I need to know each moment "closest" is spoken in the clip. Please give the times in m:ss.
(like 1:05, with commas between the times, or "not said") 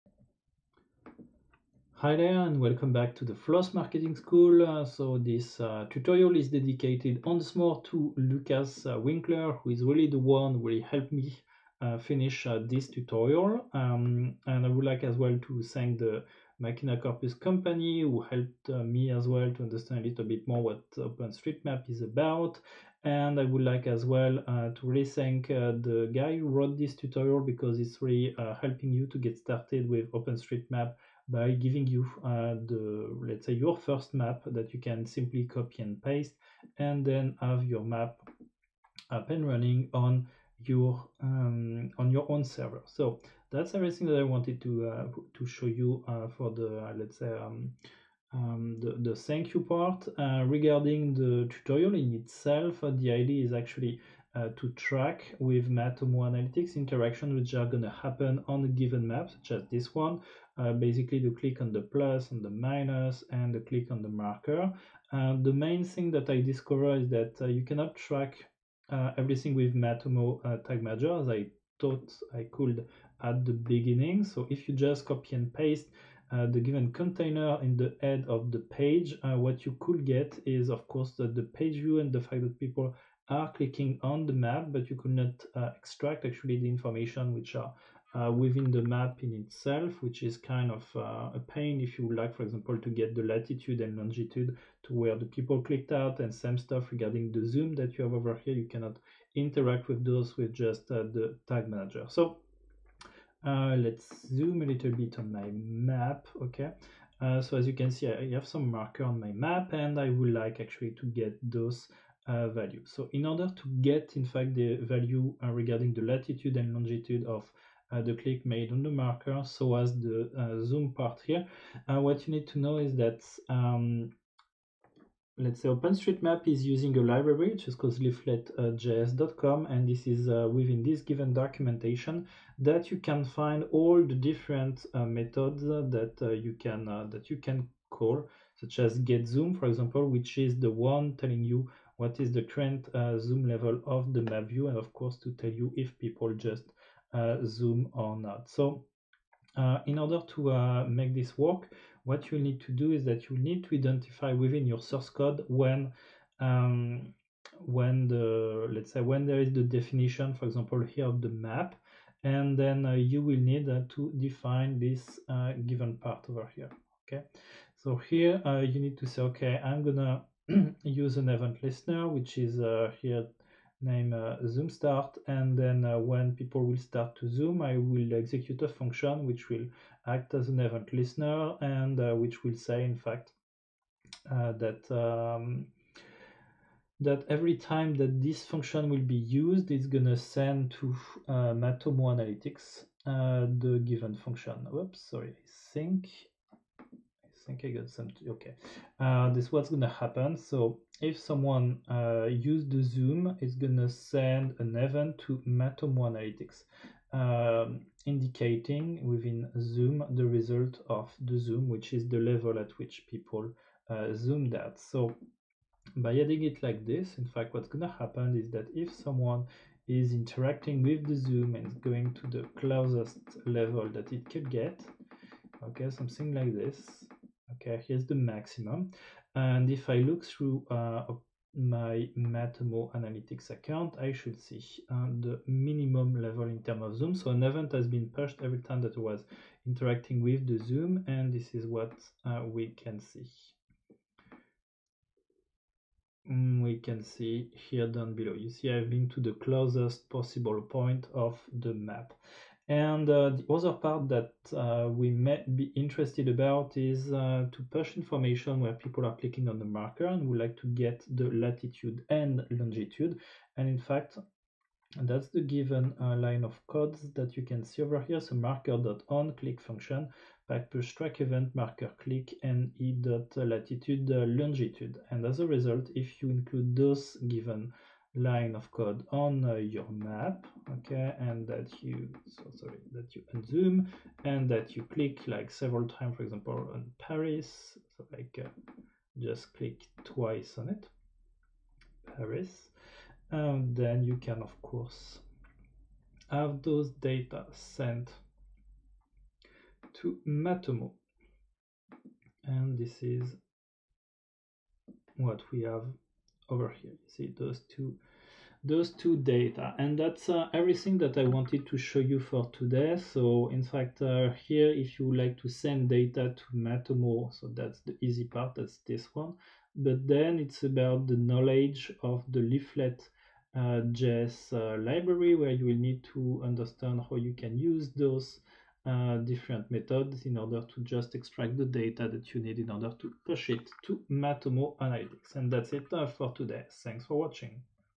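3:42, 4:09.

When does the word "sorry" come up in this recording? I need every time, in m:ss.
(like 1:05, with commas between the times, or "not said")
3:15, 4:42.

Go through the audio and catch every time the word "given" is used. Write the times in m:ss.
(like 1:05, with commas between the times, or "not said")
0:58, 1:16, 2:11, 2:45, 3:13, 4:25, 4:37.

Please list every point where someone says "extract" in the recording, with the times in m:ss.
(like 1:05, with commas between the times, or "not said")
1:25, 5:31.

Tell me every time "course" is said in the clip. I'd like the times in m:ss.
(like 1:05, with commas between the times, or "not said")
1:20, 2:24, 4:54.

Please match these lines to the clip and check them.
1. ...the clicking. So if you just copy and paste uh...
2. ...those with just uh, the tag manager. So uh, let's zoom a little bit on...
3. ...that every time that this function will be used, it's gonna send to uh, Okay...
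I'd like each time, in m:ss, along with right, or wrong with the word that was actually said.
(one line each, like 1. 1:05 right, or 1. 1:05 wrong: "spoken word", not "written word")
1. 1:13 wrong: "beginning", not "clicking"
2. 1:40 right
3. 3:06 wrong: "Matomo", not "Okay".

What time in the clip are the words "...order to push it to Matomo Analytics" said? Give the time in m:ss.
5:32.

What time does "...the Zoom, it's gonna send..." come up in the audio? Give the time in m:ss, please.
3:22.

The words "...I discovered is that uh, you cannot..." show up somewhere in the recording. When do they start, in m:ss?
1:06.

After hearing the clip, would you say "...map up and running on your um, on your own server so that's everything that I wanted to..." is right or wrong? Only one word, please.
right.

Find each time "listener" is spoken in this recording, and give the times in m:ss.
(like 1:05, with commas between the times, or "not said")
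2:51, 3:00.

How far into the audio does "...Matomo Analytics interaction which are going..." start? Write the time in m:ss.
0:55.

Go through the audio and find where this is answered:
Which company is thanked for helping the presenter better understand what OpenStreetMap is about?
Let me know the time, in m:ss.
0:16.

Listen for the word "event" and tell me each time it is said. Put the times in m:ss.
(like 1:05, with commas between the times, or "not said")
2:51, 3:00, 3:24, 3:57, 4:31.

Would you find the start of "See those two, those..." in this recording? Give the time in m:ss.
5:07.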